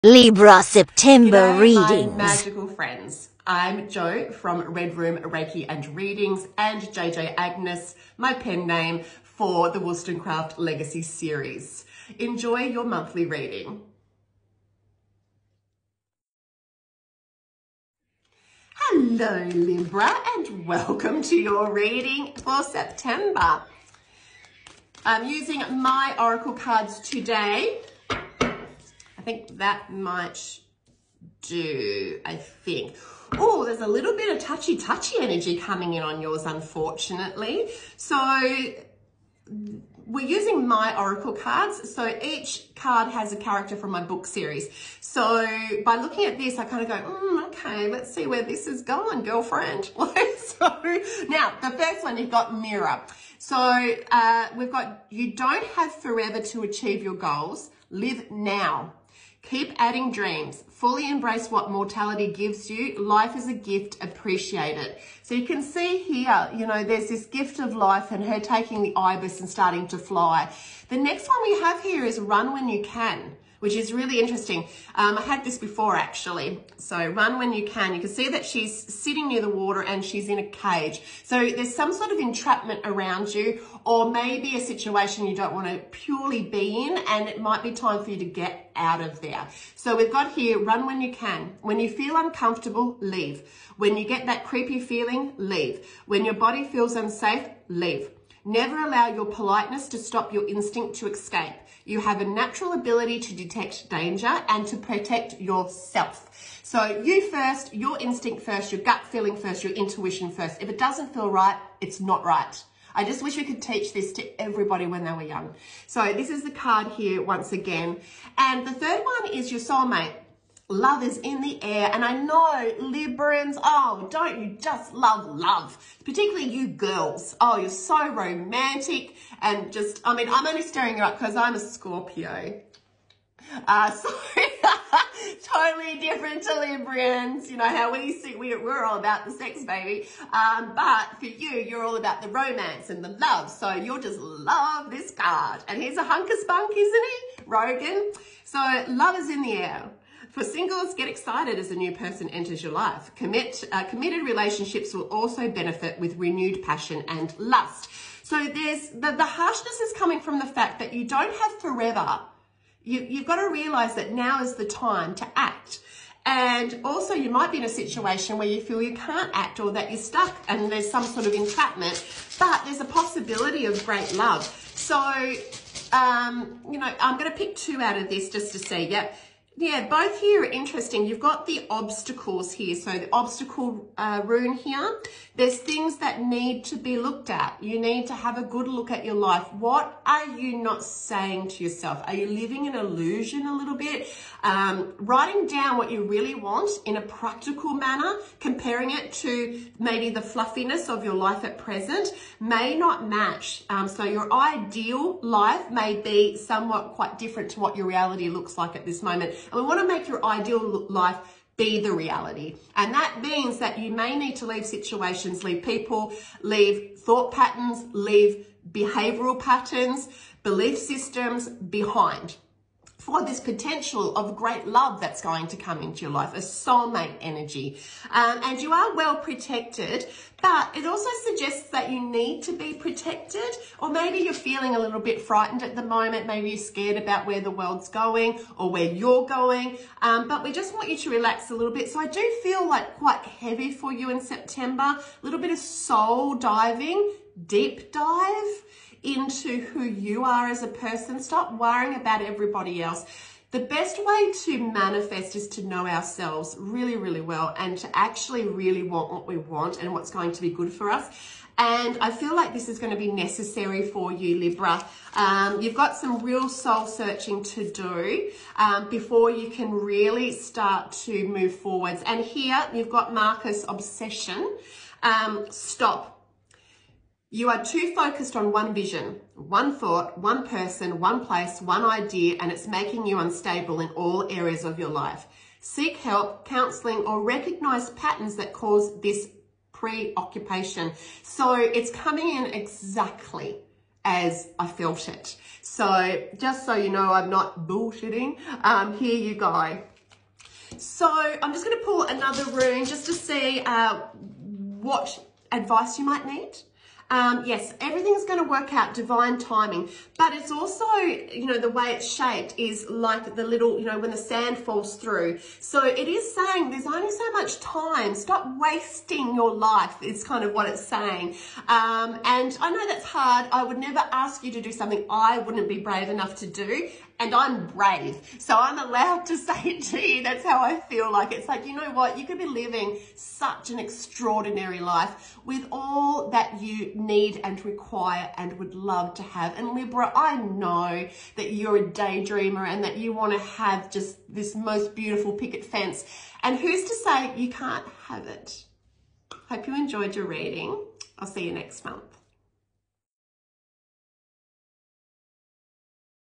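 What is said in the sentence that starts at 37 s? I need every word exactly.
So we're using my oracle cards.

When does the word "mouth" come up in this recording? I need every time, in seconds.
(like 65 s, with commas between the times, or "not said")
not said.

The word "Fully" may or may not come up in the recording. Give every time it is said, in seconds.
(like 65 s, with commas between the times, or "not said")
60 s.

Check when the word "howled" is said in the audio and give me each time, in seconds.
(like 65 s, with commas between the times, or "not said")
not said.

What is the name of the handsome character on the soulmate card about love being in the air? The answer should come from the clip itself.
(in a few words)
Rogan.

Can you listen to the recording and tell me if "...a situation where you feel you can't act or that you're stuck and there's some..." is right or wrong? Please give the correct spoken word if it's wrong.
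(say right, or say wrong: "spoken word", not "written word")
right.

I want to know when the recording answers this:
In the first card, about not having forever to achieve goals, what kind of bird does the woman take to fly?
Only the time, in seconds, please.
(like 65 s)
68 s.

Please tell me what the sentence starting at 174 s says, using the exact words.
So, um, you know, I'm going to pick two out of this just to see.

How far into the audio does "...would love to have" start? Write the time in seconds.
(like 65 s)
338 s.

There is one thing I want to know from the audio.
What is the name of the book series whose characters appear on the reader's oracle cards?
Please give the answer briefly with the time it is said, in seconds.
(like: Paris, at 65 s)
Wollstonecraft Legacy, at 9 s.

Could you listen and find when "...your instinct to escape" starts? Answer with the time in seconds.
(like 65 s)
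100 s.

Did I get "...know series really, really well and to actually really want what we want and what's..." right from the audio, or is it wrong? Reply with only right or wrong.
wrong.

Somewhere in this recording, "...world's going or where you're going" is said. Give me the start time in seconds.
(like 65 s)
237 s.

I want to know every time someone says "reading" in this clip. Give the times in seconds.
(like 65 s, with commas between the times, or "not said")
1 s, 5 s, 13 s, 21 s, 350 s.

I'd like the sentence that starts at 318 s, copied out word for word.
Stop wasting your life is kind of what it's saying.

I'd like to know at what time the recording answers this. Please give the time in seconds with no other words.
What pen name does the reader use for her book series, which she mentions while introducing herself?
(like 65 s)
6 s.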